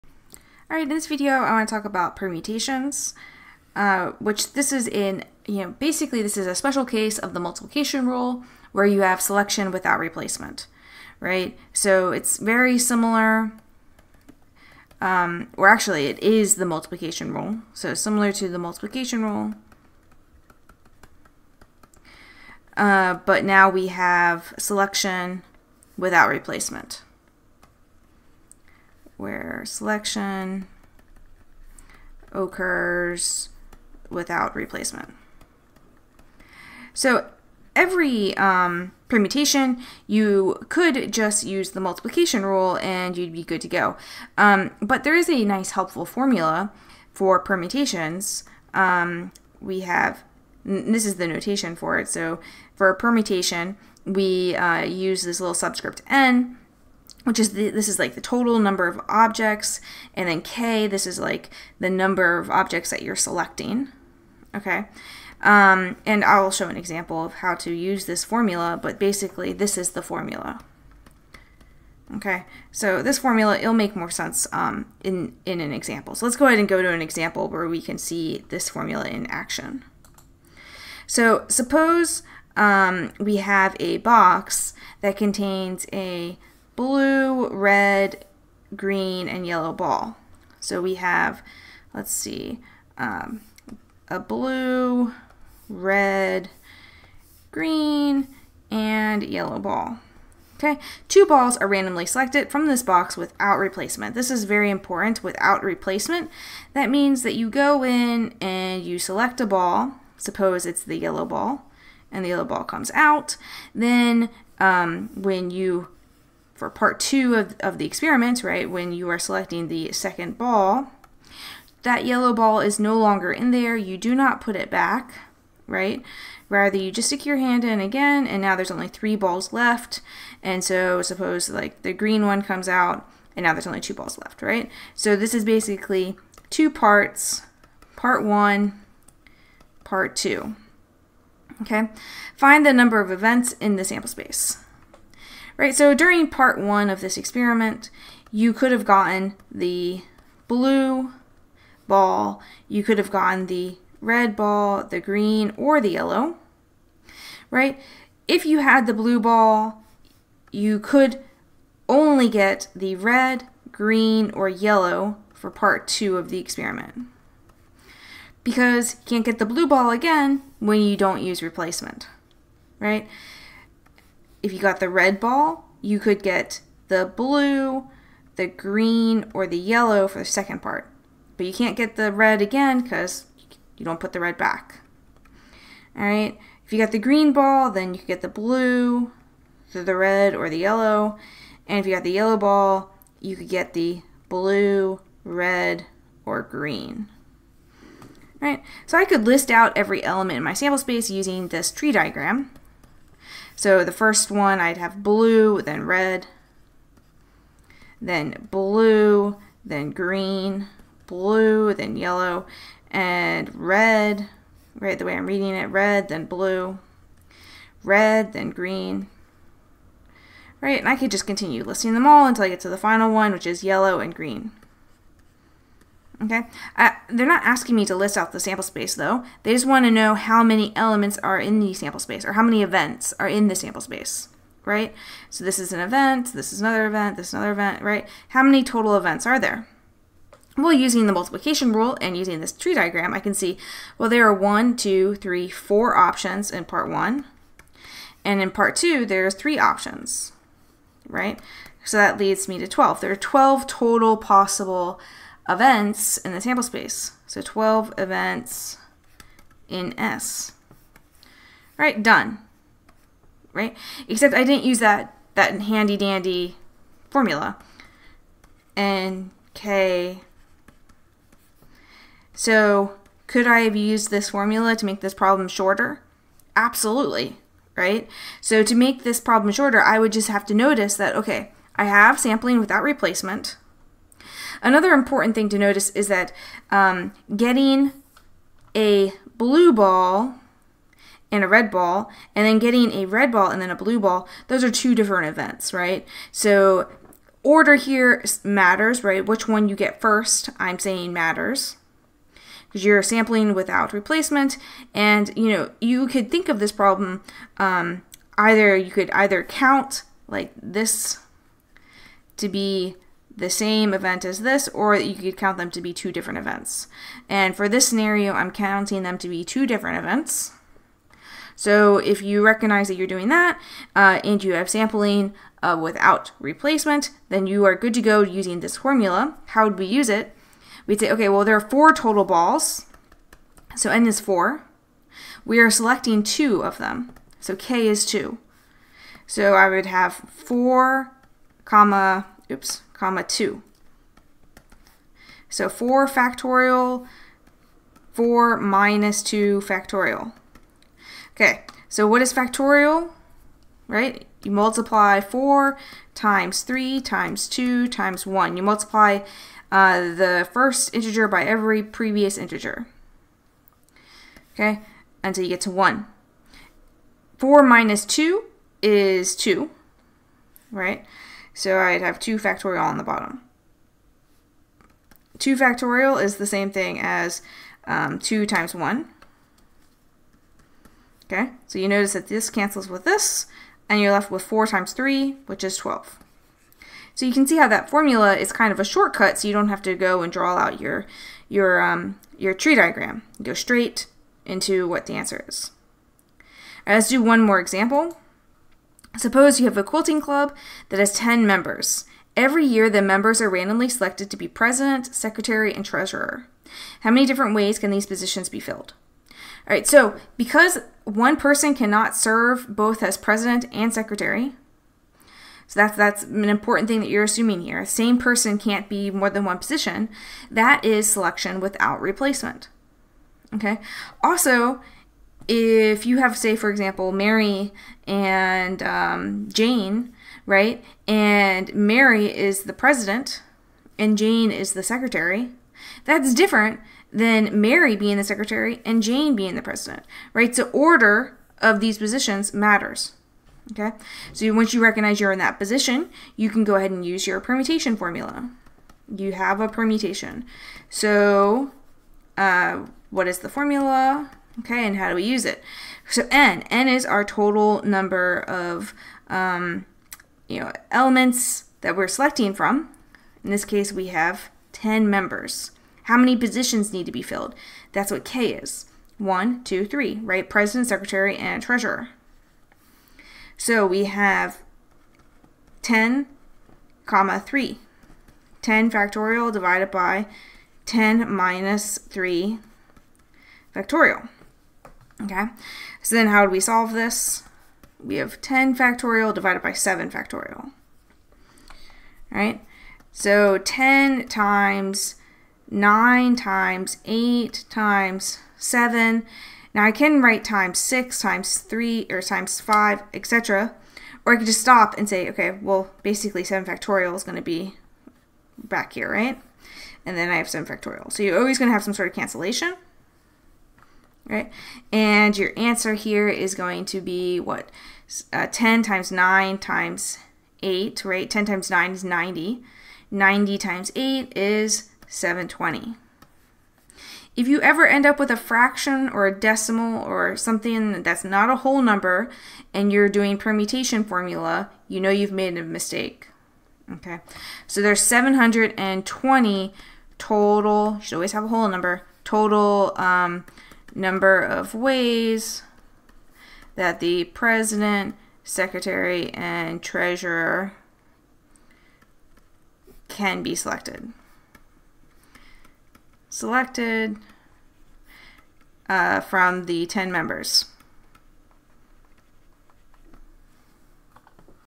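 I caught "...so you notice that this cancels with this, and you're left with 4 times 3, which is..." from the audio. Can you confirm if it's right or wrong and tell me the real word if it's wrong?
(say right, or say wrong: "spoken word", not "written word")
right.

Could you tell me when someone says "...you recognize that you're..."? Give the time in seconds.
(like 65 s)
322 s.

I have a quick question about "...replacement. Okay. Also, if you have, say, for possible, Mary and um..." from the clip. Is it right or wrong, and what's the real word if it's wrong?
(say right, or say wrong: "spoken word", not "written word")
wrong: "example", not "possible".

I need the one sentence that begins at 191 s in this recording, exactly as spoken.
And if you got the yellow ball, you could get the blue, red, or green.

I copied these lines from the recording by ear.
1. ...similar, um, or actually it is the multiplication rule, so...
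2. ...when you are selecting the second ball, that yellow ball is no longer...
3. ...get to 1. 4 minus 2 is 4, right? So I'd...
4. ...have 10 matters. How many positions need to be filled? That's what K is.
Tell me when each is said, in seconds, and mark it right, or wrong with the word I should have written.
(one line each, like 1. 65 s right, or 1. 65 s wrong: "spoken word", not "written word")
1. 12 s right
2. 118 s right
3. 365 s wrong: "2", not "4"
4. 464 s wrong: "members", not "matters".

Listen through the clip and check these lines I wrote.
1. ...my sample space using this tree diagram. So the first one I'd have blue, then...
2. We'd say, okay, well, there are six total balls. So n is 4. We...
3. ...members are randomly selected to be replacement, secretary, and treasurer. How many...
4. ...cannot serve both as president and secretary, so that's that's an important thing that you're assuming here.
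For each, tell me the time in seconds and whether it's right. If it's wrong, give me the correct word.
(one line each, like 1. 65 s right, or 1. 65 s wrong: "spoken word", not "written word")
1. 200 s right
2. 330 s wrong: "four", not "six"
3. 403 s wrong: "president", not "replacement"
4. 411 s right.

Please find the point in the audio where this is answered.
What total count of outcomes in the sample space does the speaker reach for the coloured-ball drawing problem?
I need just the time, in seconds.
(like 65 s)
253 s.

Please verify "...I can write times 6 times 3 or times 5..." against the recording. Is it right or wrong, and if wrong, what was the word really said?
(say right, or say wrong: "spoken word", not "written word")
right.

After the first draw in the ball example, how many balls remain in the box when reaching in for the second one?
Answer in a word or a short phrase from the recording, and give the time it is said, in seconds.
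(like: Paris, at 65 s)
3, at 128 s.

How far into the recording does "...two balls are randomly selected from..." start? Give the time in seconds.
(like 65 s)
101 s.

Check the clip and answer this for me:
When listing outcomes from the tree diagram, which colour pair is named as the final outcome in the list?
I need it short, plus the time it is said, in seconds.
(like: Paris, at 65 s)
Yellow and green, at 223 s.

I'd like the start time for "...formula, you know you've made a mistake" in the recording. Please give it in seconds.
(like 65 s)
534 s.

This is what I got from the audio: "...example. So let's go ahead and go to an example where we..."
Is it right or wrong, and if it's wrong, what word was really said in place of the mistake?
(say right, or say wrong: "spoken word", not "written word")
right.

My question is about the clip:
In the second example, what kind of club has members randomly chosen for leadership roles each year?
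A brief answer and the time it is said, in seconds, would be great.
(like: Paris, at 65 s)
Quilting club, at 399 s.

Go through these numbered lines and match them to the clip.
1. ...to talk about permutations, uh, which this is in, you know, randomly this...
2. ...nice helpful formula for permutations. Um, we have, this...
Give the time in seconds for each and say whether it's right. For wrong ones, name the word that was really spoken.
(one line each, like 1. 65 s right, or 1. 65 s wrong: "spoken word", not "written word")
1. 1 s wrong: "basically", not "randomly"
2. 45 s right.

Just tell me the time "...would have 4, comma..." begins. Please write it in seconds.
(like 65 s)
339 s.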